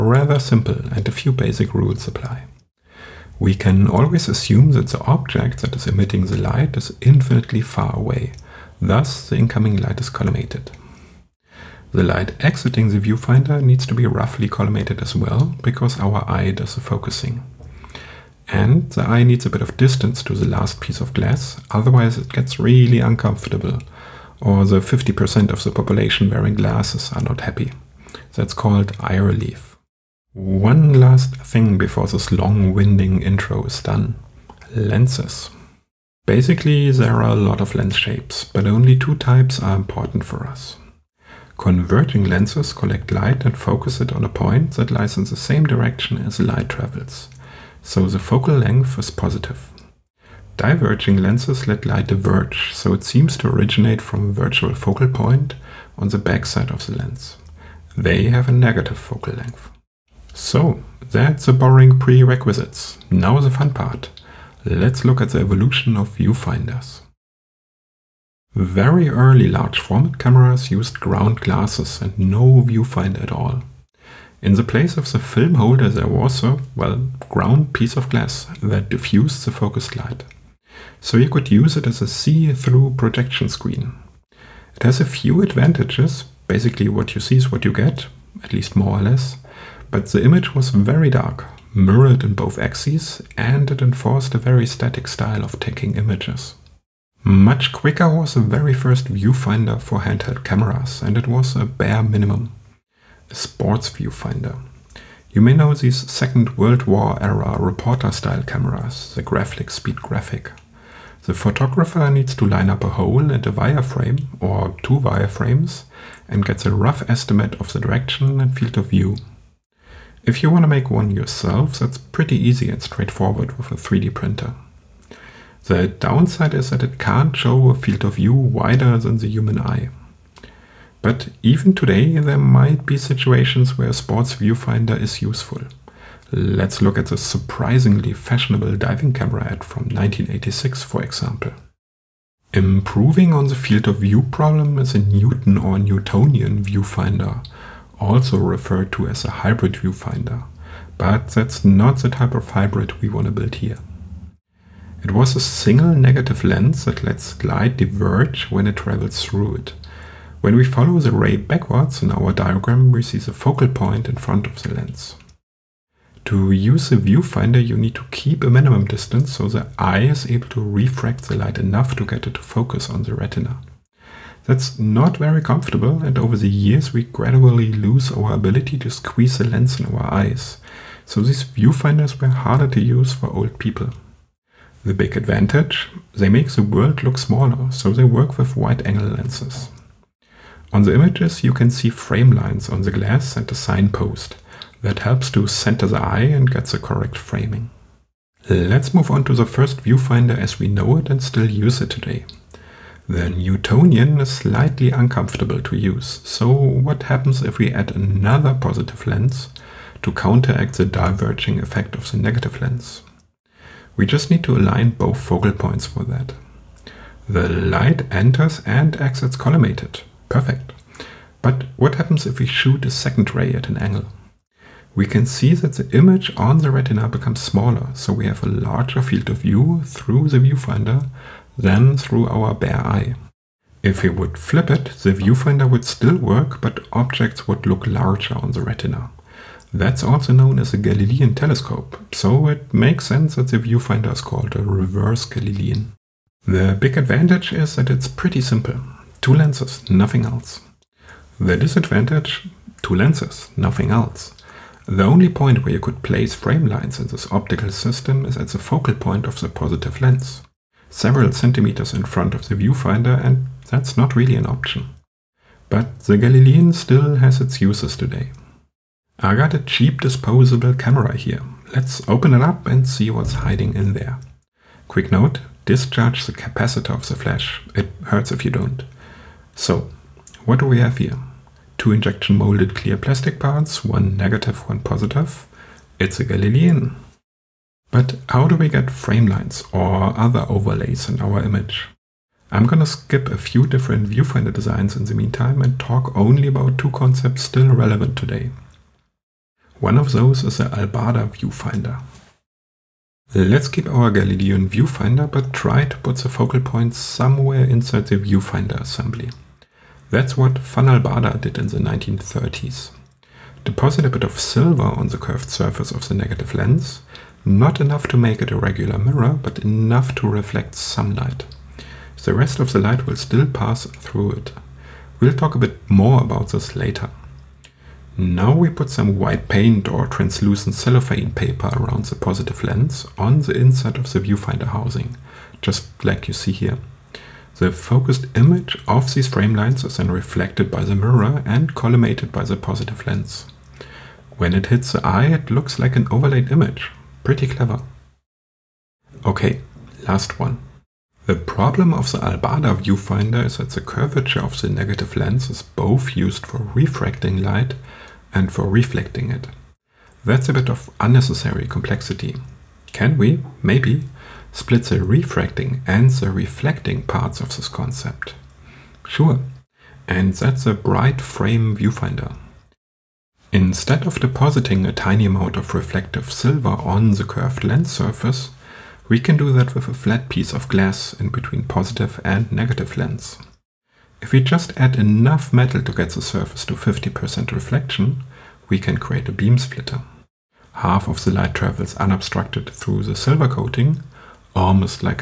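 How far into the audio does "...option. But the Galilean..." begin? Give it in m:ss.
4:24.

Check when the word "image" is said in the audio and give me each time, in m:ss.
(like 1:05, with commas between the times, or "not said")
1:30, 1:35, 3:10, 3:45, 4:51, 5:38, 5:46.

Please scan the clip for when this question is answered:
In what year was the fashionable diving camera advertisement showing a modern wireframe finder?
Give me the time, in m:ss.
2:19.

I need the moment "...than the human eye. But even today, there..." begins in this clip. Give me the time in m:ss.
2:08.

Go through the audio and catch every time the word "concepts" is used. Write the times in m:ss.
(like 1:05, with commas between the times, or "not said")
4:56, 6:07.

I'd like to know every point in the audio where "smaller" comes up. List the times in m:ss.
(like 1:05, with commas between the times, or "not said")
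3:07, 3:47.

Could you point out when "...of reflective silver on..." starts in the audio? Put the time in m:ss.
6:15.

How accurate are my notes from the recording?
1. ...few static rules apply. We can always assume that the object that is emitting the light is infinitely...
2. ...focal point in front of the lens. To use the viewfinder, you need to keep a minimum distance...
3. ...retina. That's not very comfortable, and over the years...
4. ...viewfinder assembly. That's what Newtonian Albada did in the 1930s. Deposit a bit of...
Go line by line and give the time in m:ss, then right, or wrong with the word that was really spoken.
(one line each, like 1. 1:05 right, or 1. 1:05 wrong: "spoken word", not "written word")
1. 0:01 wrong: "basic", not "static"
2. 2:43 right
3. 2:53 right
4. 5:08 wrong: "Van", not "Newtonian".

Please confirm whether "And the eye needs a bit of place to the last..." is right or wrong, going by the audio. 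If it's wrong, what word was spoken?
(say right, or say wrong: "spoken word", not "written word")
wrong: "distance", not "place".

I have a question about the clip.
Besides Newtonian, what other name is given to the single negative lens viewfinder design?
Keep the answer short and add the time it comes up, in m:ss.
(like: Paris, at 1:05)
Hybrid viewfinder, at 2:29.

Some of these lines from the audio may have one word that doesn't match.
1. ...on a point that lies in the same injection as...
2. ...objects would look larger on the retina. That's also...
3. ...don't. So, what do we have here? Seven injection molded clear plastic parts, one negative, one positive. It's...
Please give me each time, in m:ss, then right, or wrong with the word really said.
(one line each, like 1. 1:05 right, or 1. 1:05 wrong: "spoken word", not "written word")
1. 0:44 wrong: "direction", not "injection"
2. 3:56 right
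3. 4:38 wrong: "Two", not "Seven".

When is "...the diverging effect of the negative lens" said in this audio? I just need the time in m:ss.
3:30.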